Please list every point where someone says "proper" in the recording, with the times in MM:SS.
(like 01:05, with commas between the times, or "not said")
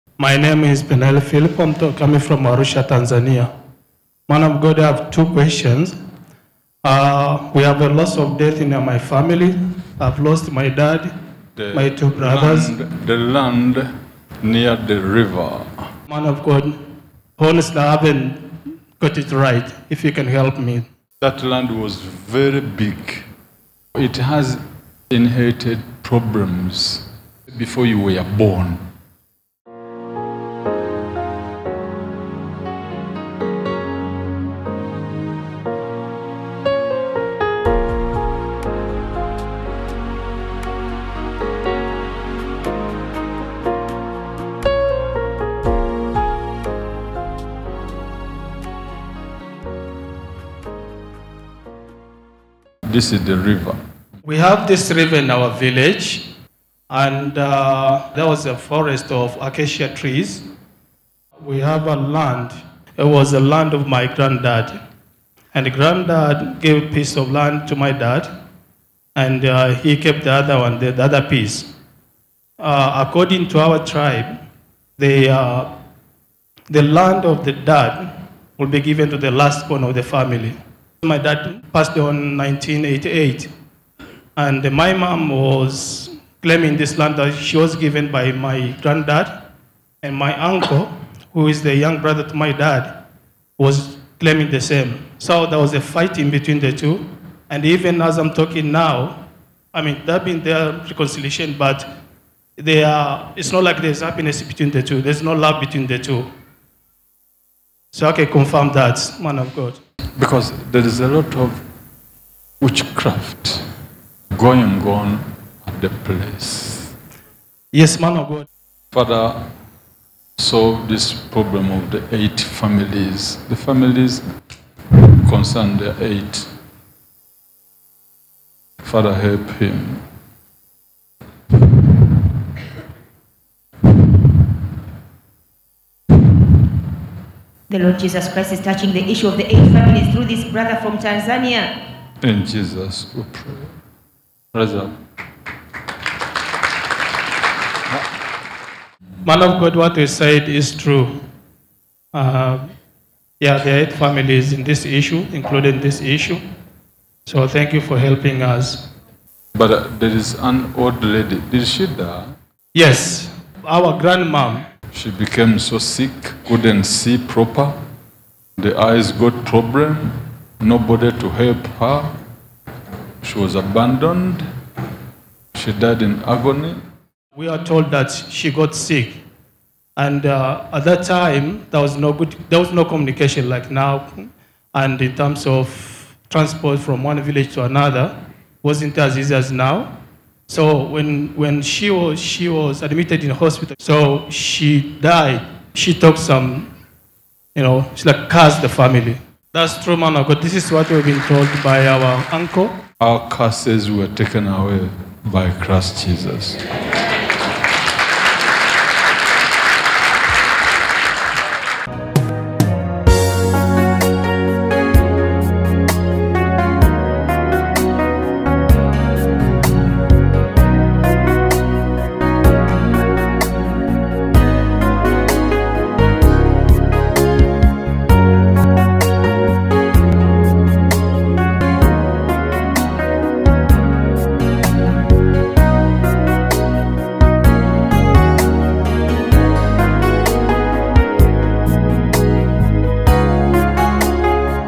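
02:47.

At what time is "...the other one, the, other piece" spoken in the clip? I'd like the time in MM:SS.
01:10.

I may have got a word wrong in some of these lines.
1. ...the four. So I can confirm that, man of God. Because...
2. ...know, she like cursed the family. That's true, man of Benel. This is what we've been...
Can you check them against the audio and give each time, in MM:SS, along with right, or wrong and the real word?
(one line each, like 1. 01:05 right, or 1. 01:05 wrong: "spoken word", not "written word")
1. 01:45 wrong: "two", not "four"
2. 03:17 wrong: "God", not "Benel".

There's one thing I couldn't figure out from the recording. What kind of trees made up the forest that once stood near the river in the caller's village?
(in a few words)
acacia.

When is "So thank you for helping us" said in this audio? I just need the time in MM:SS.
02:37.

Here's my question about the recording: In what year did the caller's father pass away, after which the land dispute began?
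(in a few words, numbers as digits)
1988.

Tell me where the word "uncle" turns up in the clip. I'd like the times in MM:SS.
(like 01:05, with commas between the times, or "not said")
01:30, 03:22.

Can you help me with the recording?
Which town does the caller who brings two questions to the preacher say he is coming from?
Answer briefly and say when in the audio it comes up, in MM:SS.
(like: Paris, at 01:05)
Arusha, at 00:02.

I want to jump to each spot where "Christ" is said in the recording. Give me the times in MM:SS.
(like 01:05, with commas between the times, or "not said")
02:18, 03:25.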